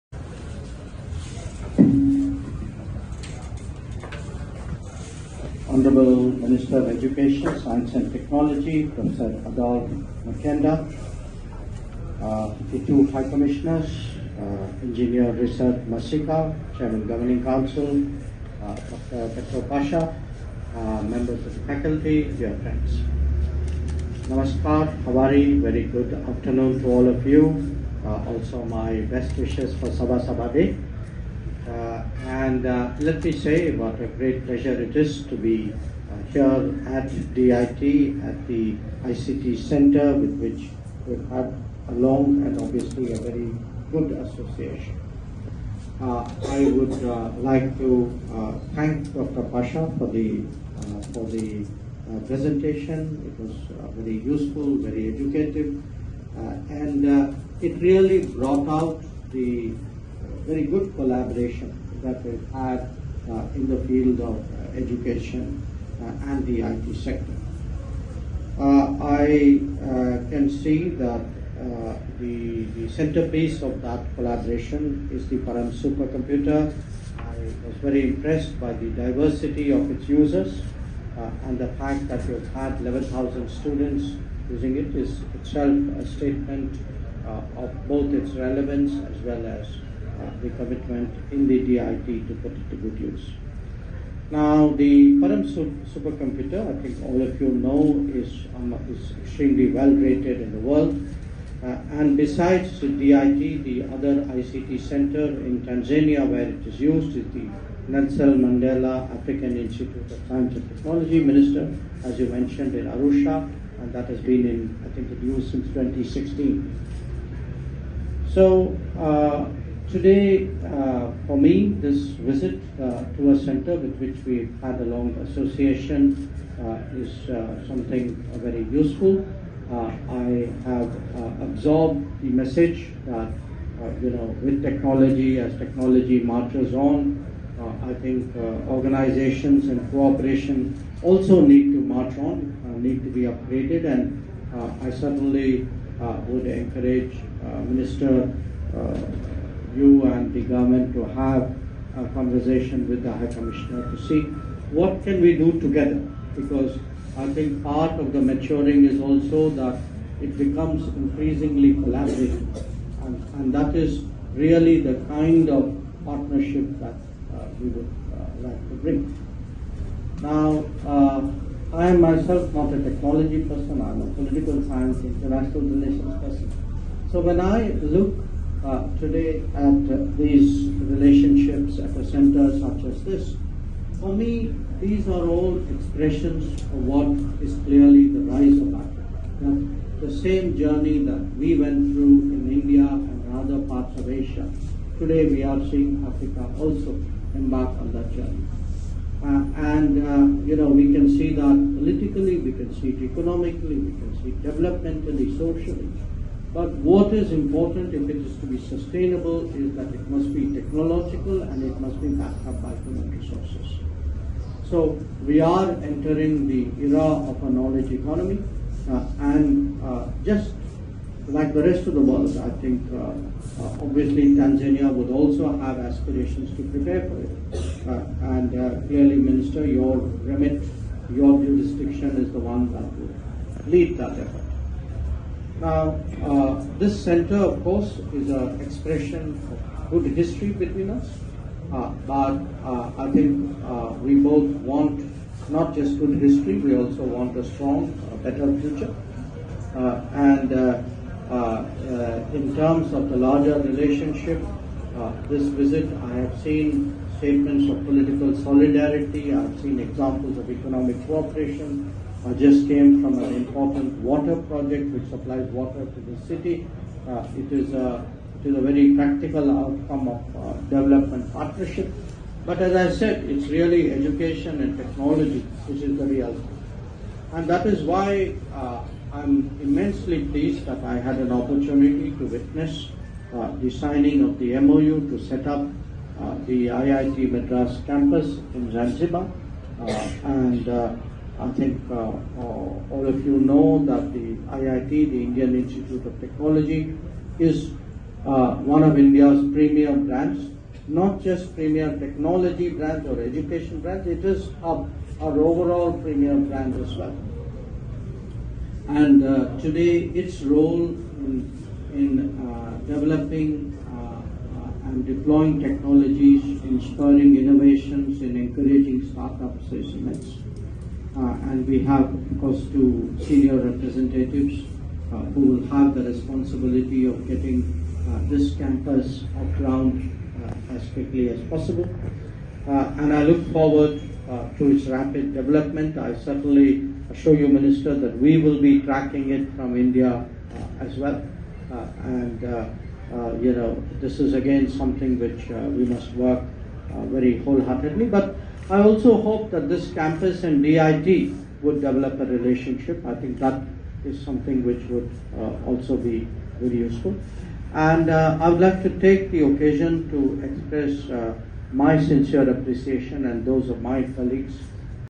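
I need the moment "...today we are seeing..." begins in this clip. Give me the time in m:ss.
3:14.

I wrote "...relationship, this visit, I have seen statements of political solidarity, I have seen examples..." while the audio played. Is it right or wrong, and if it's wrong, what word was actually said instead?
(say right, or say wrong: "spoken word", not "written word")
right.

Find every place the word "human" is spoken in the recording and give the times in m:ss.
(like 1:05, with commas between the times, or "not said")
3:32.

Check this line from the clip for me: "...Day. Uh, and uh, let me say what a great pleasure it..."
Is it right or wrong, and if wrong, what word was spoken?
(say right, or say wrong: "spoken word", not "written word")
right.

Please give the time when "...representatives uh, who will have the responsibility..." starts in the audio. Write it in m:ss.
5:23.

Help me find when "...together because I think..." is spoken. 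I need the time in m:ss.
2:35.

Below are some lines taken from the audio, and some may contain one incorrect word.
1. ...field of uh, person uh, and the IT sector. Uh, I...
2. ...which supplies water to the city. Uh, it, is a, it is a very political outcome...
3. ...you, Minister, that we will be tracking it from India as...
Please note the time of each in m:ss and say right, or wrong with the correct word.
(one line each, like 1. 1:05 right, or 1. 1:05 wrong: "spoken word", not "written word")
1. 1:03 wrong: "education", not "person"
2. 4:24 wrong: "practical", not "political"
3. 5:37 right.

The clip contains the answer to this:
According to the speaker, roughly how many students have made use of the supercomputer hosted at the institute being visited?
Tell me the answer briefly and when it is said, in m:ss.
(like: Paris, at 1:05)
11,000, at 1:22.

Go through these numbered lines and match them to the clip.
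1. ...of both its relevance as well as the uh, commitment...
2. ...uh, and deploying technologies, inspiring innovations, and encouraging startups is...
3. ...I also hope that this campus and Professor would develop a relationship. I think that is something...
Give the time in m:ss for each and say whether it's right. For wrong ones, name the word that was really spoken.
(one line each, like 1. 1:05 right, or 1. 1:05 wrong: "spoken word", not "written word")
1. 1:27 right
2. 5:13 right
3. 5:48 wrong: "DIT", not "Professor".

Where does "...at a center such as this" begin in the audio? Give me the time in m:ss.
3:01.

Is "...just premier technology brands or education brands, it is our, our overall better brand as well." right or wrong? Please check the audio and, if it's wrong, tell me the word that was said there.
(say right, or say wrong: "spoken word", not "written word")
wrong: "premier", not "better".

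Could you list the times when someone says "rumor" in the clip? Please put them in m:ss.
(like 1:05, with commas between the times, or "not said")
not said.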